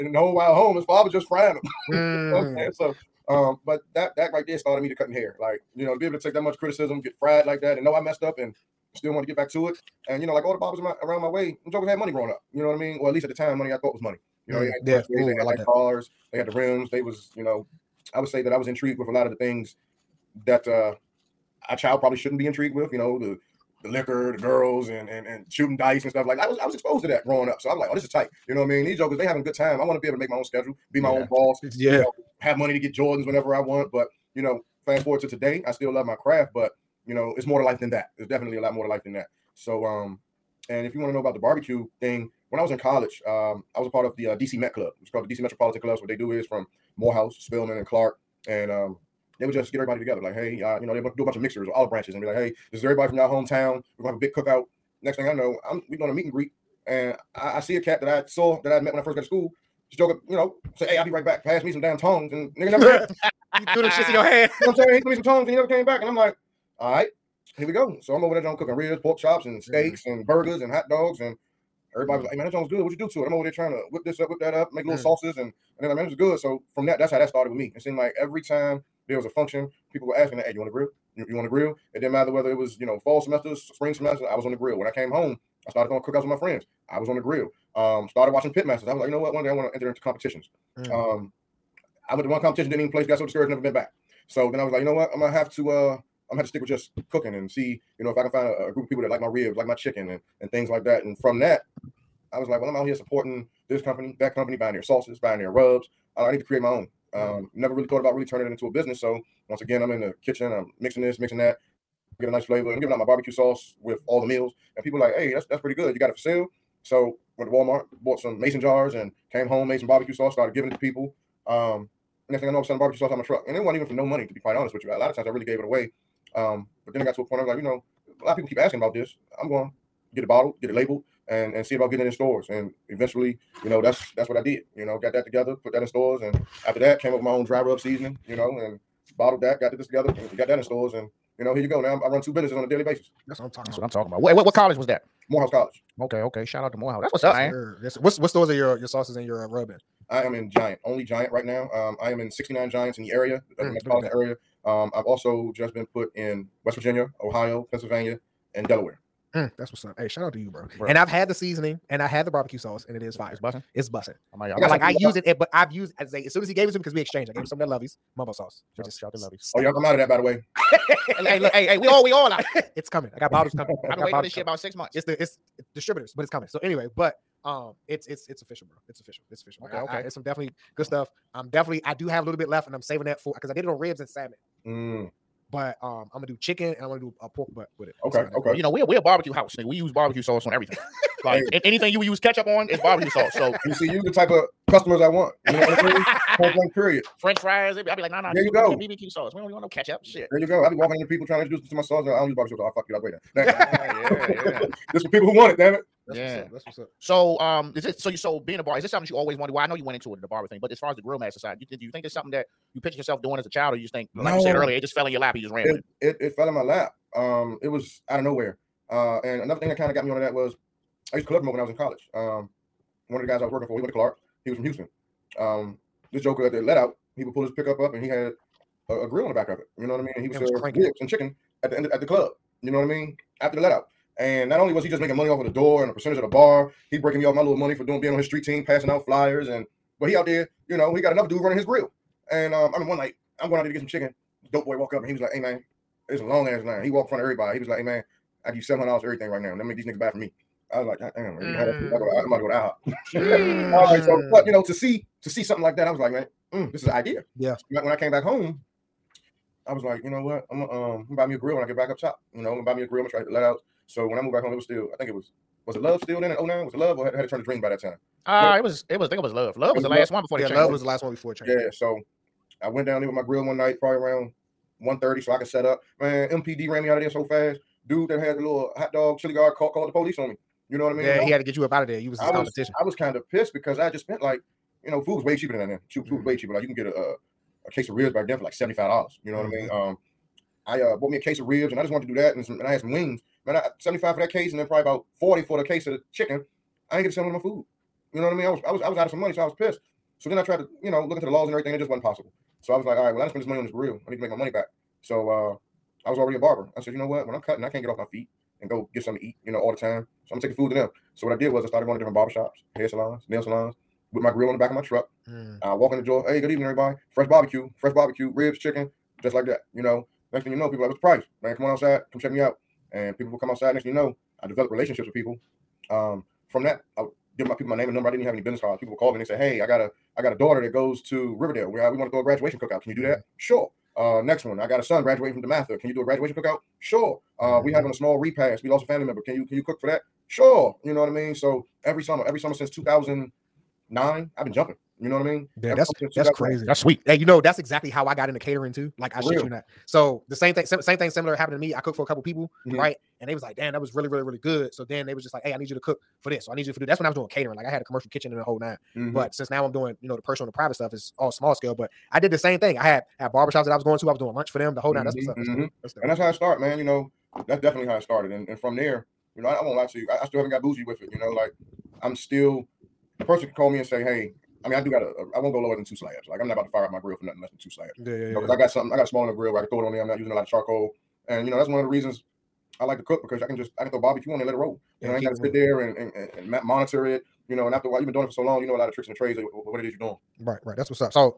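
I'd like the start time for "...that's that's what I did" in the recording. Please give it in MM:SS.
02:13.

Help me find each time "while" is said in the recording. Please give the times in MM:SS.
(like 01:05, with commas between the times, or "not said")
00:00, 06:27.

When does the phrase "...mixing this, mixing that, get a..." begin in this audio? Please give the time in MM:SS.
01:50.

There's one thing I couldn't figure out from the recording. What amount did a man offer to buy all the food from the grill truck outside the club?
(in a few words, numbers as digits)
$700.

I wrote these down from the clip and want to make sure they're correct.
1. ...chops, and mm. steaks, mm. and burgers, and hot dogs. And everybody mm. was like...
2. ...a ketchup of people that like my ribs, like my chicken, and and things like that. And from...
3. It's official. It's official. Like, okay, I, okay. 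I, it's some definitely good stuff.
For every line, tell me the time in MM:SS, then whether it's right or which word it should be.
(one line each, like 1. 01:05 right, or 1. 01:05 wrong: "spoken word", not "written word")
1. 01:09 right
2. 01:38 wrong: "group", not "ketchup"
3. 02:58 right.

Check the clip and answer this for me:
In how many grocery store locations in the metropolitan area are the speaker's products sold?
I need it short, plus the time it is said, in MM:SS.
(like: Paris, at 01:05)
69, at 02:32.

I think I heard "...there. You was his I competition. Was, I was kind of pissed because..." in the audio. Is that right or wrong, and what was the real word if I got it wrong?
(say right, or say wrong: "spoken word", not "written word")
right.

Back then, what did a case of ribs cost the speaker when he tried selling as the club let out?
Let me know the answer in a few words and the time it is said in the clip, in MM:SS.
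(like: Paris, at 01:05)
$75, at 04:48.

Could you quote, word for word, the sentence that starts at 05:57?
Like I had a commercial kitchen and a whole nine.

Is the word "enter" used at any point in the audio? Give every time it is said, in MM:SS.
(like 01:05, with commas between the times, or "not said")
01:29.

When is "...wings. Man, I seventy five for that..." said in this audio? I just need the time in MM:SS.
04:52.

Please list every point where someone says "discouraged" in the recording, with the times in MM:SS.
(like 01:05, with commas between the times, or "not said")
01:33.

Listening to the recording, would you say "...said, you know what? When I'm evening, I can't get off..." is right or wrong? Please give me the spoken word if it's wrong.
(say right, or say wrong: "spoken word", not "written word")
wrong: "cutting", not "evening".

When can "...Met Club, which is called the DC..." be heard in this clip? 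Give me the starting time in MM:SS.
00:44.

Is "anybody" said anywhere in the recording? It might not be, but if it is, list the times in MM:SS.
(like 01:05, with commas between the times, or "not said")
not said.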